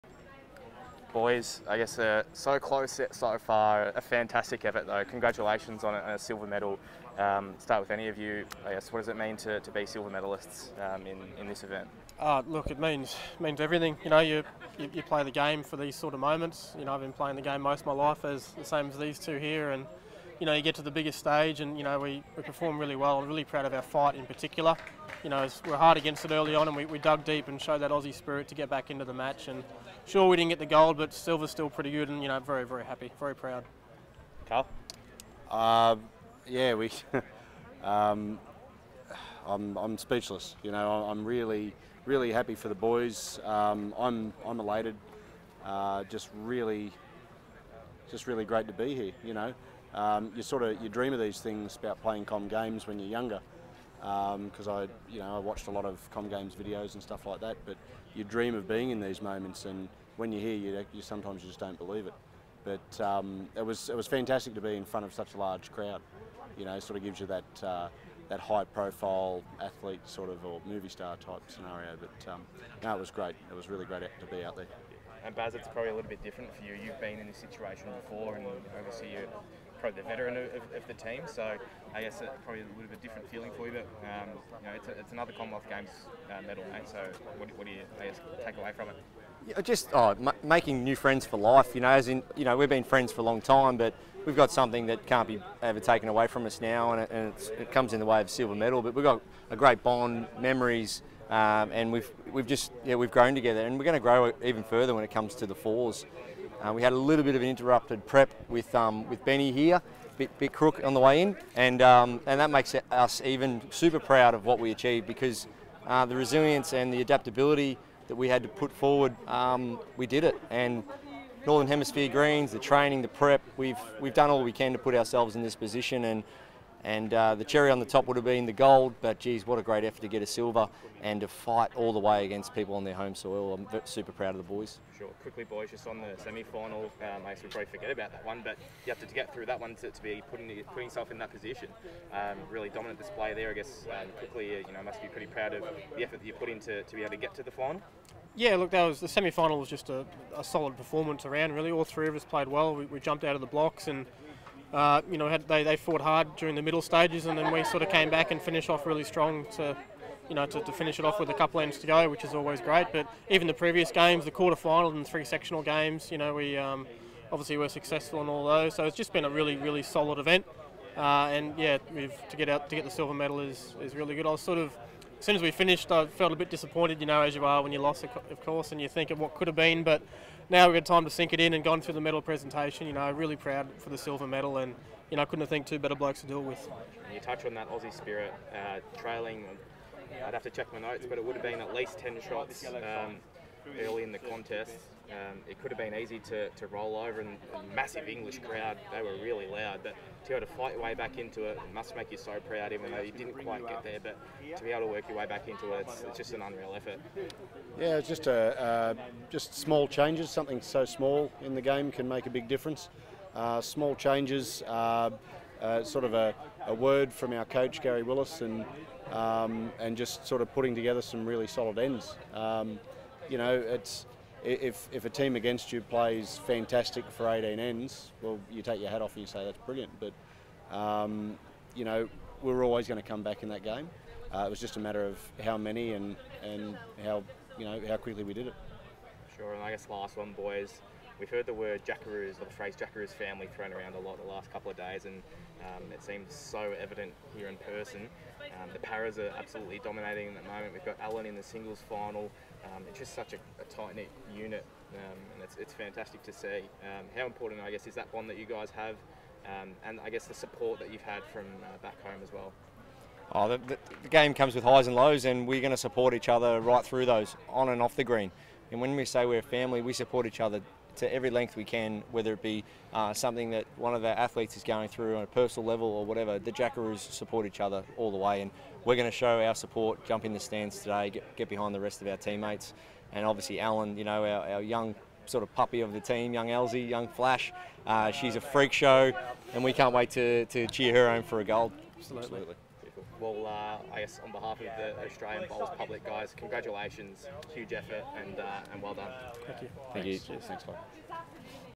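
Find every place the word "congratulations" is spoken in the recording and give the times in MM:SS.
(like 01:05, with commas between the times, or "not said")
00:05, 04:56.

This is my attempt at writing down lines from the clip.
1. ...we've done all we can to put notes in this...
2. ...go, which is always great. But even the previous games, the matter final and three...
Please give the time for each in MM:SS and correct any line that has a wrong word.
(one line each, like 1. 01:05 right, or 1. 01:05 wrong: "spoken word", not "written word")
1. 02:03 wrong: "ourselves", not "notes"
2. 02:41 wrong: "quarter", not "matter".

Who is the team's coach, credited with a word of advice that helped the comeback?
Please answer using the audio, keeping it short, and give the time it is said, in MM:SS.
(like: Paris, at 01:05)
Gary Willis, at 03:37.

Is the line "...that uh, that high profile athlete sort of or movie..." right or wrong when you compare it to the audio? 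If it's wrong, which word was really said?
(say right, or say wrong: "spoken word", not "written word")
right.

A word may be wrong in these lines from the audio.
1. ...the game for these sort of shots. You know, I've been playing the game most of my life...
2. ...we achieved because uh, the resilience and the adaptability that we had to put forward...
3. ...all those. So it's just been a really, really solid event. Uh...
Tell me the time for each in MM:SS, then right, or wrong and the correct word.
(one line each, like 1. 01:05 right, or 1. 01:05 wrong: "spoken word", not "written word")
1. 00:15 wrong: "moments", not "shots"
2. 01:54 right
3. 02:48 right.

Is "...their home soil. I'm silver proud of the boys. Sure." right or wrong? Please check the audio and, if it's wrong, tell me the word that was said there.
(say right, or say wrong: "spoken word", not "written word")
wrong: "super", not "silver".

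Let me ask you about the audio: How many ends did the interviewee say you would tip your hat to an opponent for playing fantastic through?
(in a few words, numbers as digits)
18.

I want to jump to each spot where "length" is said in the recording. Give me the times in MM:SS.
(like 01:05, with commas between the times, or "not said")
04:31.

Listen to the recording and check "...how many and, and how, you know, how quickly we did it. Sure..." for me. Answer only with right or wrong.
right.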